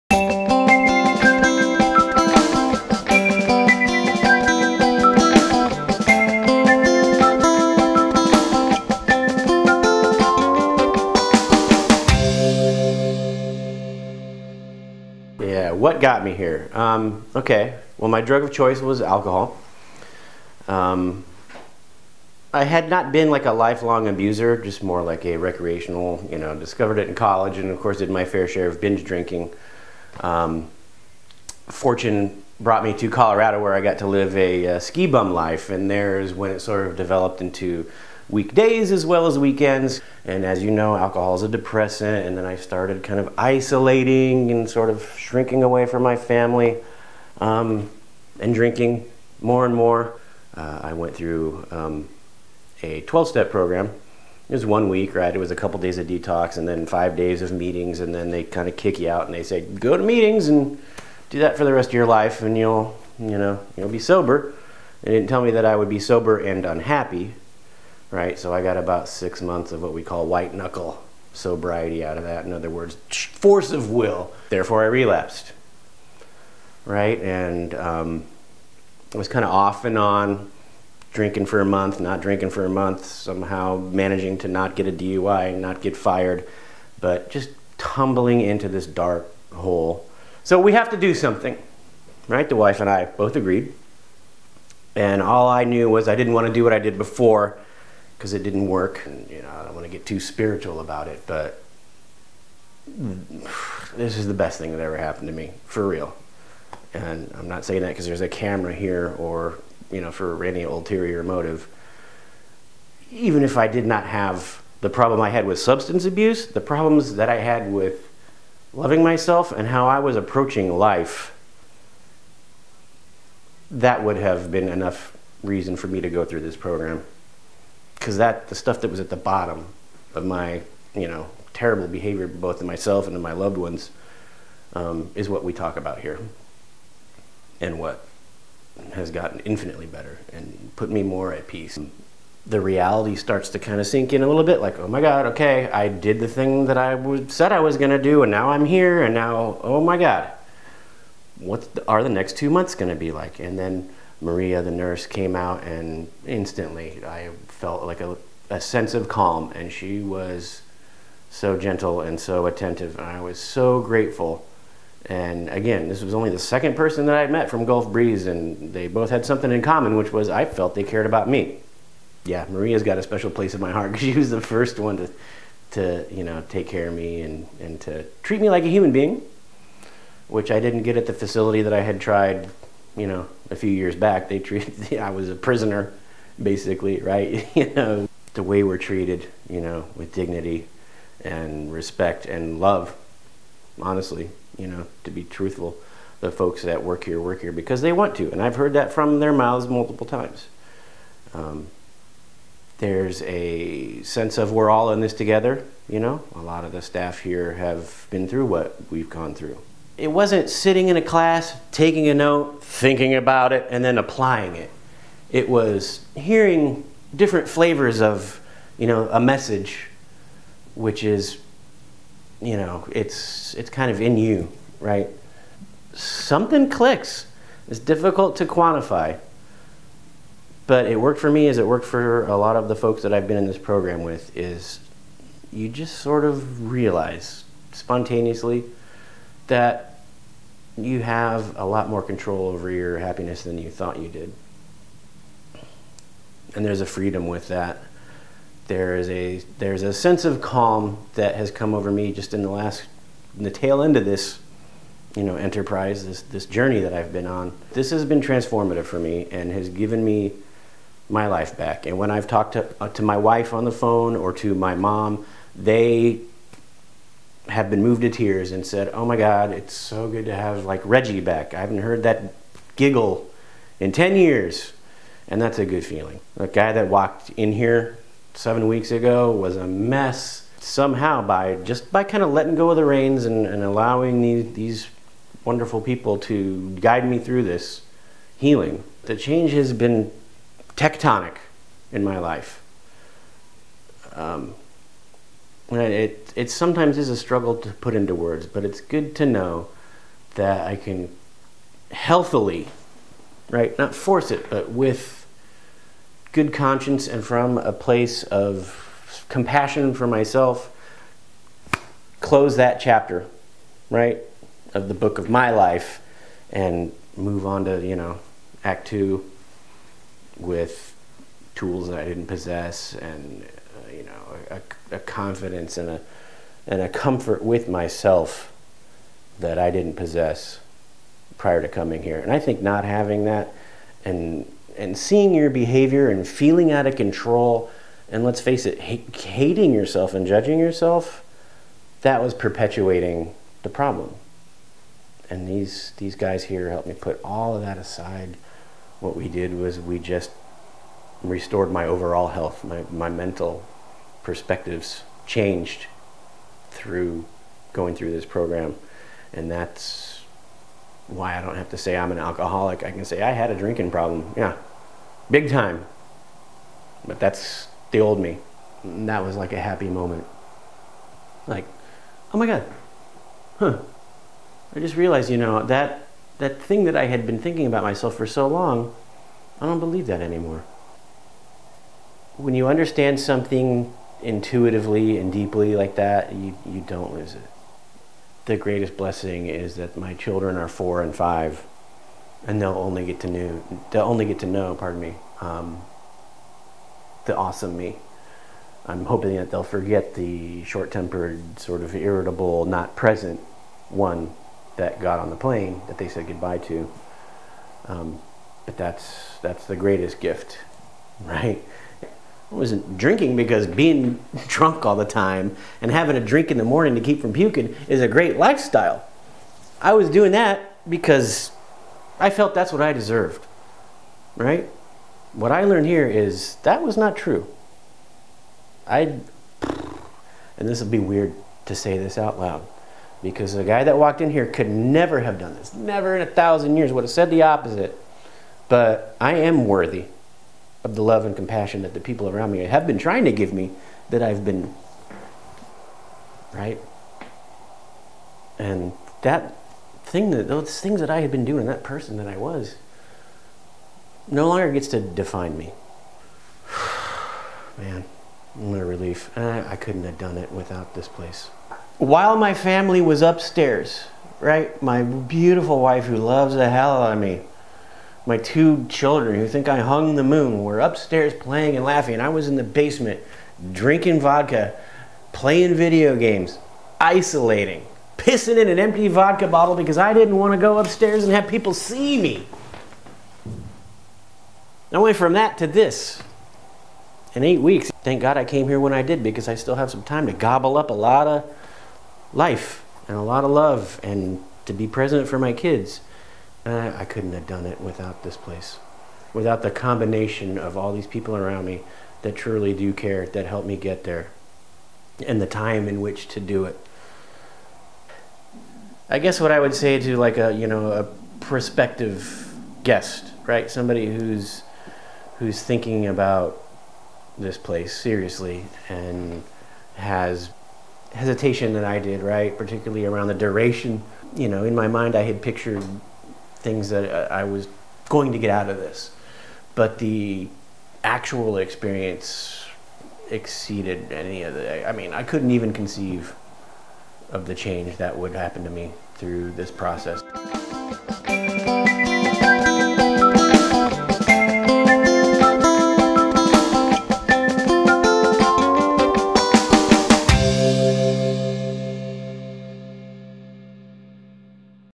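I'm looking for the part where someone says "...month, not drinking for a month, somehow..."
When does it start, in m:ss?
1:21.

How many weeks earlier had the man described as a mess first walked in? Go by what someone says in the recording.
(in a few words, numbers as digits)
7.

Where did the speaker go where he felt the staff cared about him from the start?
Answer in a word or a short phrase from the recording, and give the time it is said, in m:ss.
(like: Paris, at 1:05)
Gulf Breeze, at 2:47.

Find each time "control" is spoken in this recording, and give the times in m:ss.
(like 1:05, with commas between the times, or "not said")
4:02, 5:36.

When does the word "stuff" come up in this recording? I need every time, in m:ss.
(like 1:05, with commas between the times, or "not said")
2:08.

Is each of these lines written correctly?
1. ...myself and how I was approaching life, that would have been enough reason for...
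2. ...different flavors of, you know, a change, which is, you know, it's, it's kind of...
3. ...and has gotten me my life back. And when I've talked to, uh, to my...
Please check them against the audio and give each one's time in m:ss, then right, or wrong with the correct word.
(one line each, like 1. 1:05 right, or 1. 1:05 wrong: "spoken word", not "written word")
1. 1:59 right
2. 3:37 wrong: "message", not "change"
3. 4:19 wrong: "given", not "gotten".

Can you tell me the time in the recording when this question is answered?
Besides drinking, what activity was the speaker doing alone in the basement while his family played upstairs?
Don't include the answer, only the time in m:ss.
7:55.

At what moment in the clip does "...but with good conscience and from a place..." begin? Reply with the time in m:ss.
5:04.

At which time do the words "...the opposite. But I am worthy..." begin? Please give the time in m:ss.
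7:17.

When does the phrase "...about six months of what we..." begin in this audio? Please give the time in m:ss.
1:08.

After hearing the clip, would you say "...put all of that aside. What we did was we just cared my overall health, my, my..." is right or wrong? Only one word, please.
wrong.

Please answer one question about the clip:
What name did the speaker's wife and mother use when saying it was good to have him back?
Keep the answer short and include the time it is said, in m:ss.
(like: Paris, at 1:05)
Reggie, at 4:30.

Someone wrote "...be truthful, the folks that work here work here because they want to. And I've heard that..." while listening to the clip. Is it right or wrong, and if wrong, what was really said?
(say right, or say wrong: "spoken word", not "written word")
right.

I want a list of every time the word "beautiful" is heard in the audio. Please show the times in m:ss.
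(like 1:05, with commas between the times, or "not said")
7:45.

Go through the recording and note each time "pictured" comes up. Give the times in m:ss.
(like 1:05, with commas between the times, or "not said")
8:45.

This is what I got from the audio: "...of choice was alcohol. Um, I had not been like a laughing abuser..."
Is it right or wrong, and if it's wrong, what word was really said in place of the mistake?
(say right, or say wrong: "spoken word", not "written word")
wrong: "lifelong", not "laughing".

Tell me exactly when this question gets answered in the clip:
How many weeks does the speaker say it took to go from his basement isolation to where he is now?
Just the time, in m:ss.
8:07.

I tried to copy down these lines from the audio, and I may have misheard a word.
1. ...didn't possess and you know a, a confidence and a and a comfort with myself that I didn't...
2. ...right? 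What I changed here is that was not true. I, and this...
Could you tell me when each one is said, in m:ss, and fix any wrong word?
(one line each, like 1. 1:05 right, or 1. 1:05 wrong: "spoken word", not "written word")
1. 5:22 right
2. 7:04 wrong: "learned", not "changed".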